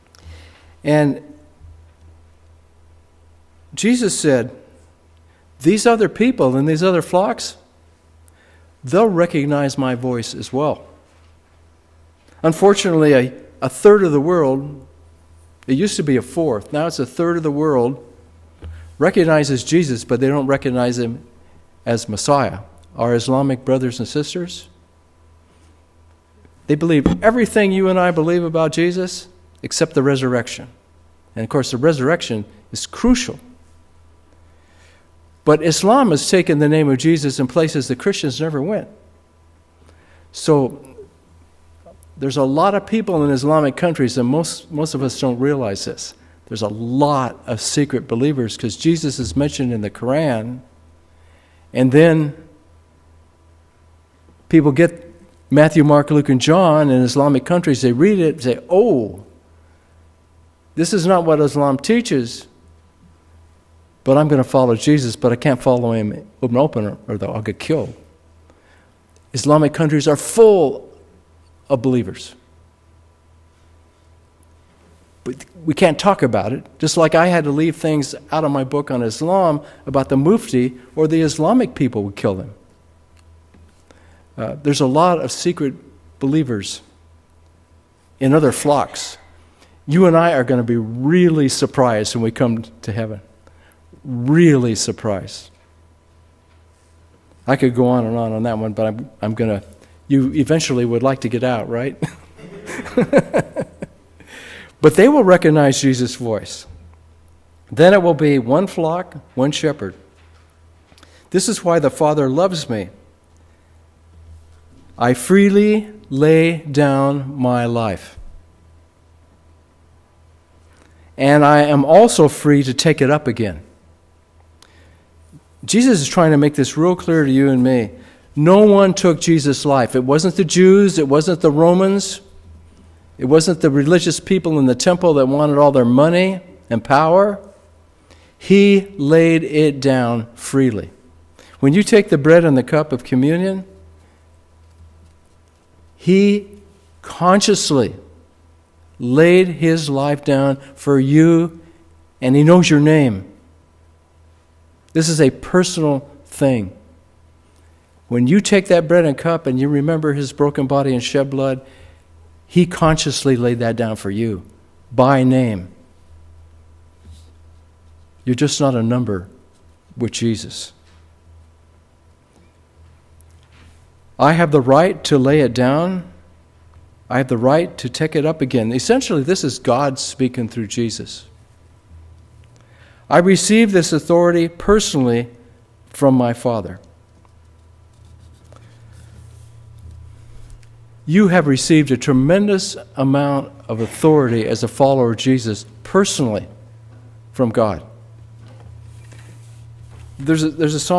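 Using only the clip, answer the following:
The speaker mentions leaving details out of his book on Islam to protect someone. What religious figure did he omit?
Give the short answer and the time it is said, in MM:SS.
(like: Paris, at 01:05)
the Mufti, at 01:20.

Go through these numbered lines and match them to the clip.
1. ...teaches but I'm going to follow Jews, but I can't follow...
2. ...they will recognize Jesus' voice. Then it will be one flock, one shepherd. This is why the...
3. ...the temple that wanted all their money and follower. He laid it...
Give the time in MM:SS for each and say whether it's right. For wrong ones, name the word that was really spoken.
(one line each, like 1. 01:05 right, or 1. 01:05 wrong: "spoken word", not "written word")
1. 01:01 wrong: "Jesus", not "Jews"
2. 01:44 right
3. 02:14 wrong: "power", not "follower".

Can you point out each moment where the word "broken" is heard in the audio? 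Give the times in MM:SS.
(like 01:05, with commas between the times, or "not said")
02:40.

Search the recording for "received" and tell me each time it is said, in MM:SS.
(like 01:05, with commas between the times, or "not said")
03:03, 03:11.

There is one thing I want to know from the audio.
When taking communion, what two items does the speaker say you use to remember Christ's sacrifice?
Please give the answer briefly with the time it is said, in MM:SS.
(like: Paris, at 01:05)
bread and cup, at 02:38.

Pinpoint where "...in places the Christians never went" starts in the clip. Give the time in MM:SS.
00:37.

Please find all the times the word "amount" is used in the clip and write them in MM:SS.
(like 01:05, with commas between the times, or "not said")
03:12.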